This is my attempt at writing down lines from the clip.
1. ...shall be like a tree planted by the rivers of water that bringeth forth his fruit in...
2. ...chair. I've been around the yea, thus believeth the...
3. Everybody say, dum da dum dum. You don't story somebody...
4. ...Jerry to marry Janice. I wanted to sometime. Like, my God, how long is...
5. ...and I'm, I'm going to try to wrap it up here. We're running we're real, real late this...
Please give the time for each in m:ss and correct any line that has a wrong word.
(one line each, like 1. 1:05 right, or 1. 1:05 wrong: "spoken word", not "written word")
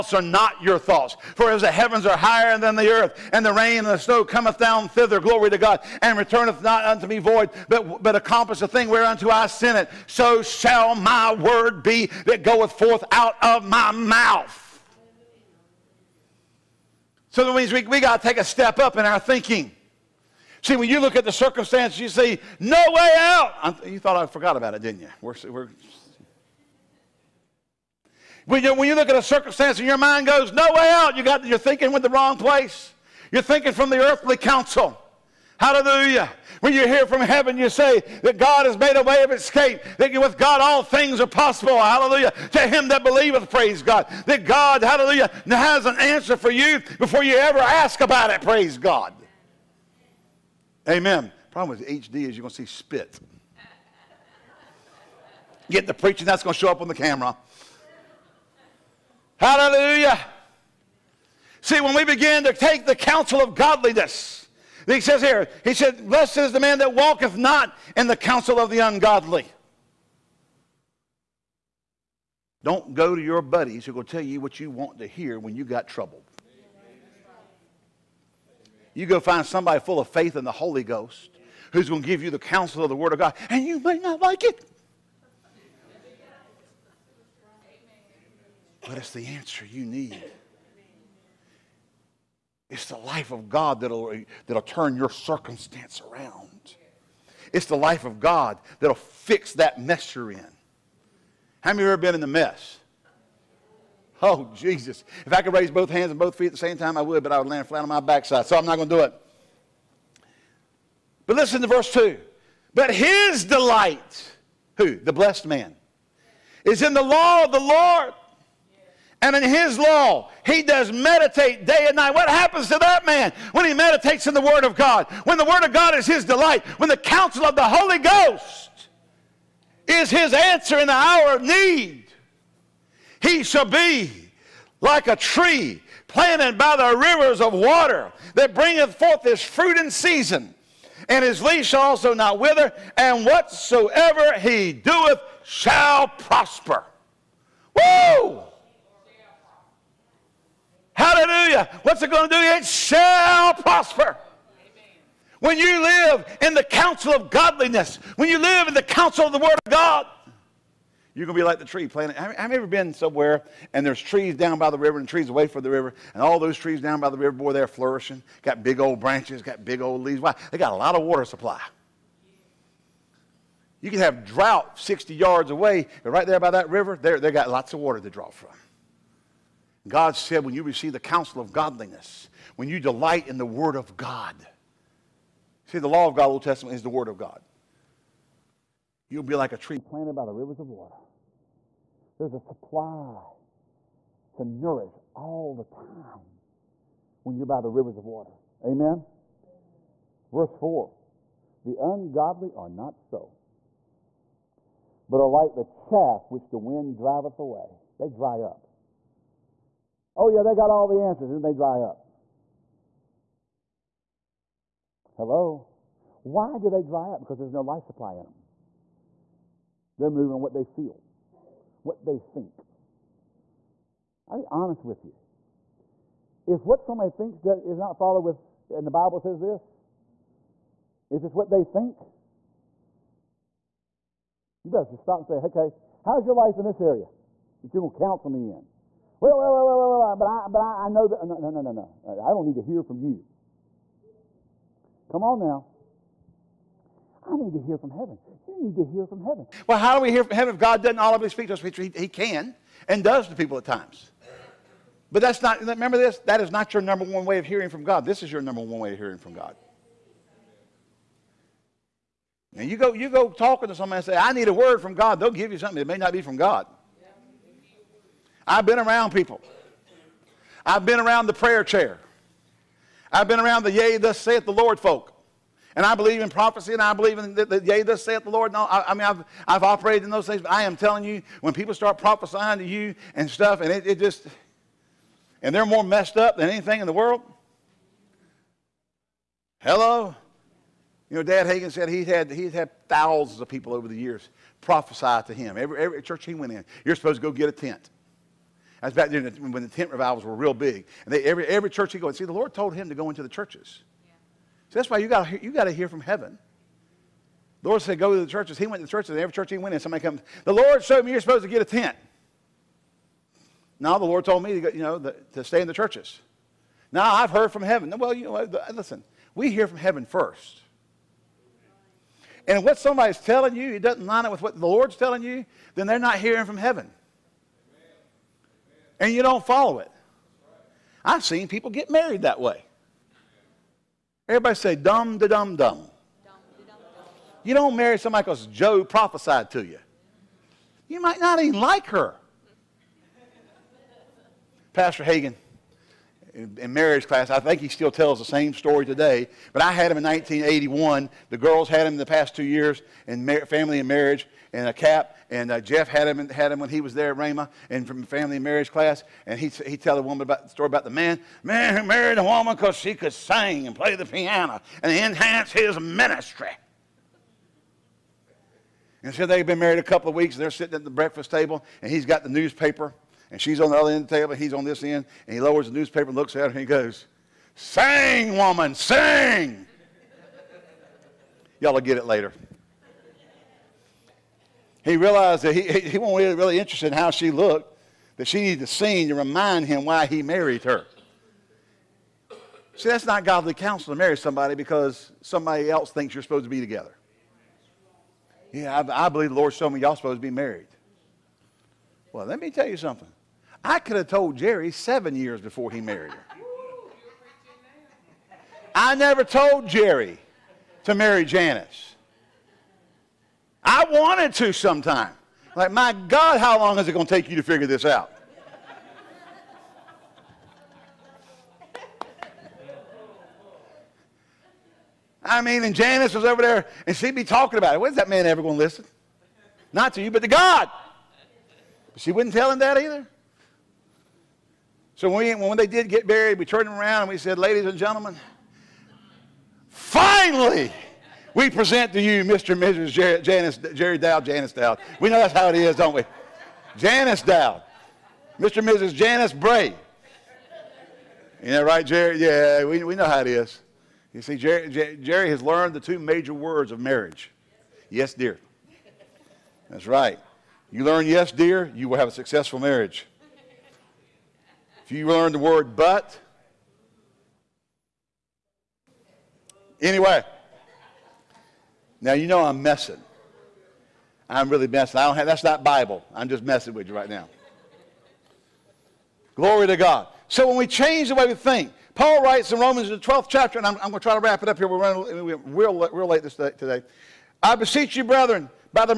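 1. 2:13 right
2. 4:31 wrong: "saith", not "believeth"
3. 5:34 wrong: "marry", not "story"
4. 6:49 right
5. 8:03 right.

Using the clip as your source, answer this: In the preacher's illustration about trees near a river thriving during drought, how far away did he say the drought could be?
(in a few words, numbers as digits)
60 yards.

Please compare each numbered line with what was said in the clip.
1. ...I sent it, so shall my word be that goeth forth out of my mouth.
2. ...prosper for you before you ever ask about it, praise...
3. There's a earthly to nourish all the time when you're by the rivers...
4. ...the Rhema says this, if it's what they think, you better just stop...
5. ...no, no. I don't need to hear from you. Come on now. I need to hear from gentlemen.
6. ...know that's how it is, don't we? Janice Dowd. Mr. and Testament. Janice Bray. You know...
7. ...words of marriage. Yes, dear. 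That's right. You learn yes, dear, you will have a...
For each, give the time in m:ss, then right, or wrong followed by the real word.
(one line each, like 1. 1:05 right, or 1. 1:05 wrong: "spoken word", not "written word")
1. 0:09 right
2. 0:45 wrong: "answer", not "prosper"
3. 3:12 wrong: "supply", not "earthly"
4. 3:48 wrong: "Bible", not "Rhema"
5. 4:01 wrong: "heaven", not "gentlemen"
6. 7:25 wrong: "Mrs", not "Testament"
7. 7:36 right.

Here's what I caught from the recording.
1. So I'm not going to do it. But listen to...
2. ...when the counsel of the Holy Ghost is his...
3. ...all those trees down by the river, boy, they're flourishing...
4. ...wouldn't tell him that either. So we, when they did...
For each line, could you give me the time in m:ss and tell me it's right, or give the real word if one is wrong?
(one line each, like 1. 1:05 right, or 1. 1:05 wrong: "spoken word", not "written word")
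1. 1:48 right
2. 2:06 right
3. 2:46 right
4. 7:12 right.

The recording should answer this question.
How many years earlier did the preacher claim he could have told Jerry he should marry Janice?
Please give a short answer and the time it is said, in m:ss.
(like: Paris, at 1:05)
7, at 6:44.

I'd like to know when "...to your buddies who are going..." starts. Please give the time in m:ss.
1:13.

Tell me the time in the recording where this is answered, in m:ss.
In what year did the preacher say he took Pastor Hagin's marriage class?
5:50.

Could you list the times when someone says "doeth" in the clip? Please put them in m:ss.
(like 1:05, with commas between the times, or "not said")
2:24.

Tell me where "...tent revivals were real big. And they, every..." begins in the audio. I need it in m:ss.
4:59.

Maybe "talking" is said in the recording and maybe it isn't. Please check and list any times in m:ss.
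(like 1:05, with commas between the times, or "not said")
4:23, 7:07.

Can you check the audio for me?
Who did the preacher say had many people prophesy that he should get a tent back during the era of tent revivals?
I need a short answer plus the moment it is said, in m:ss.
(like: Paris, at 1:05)
Dad Hagin, at 4:51.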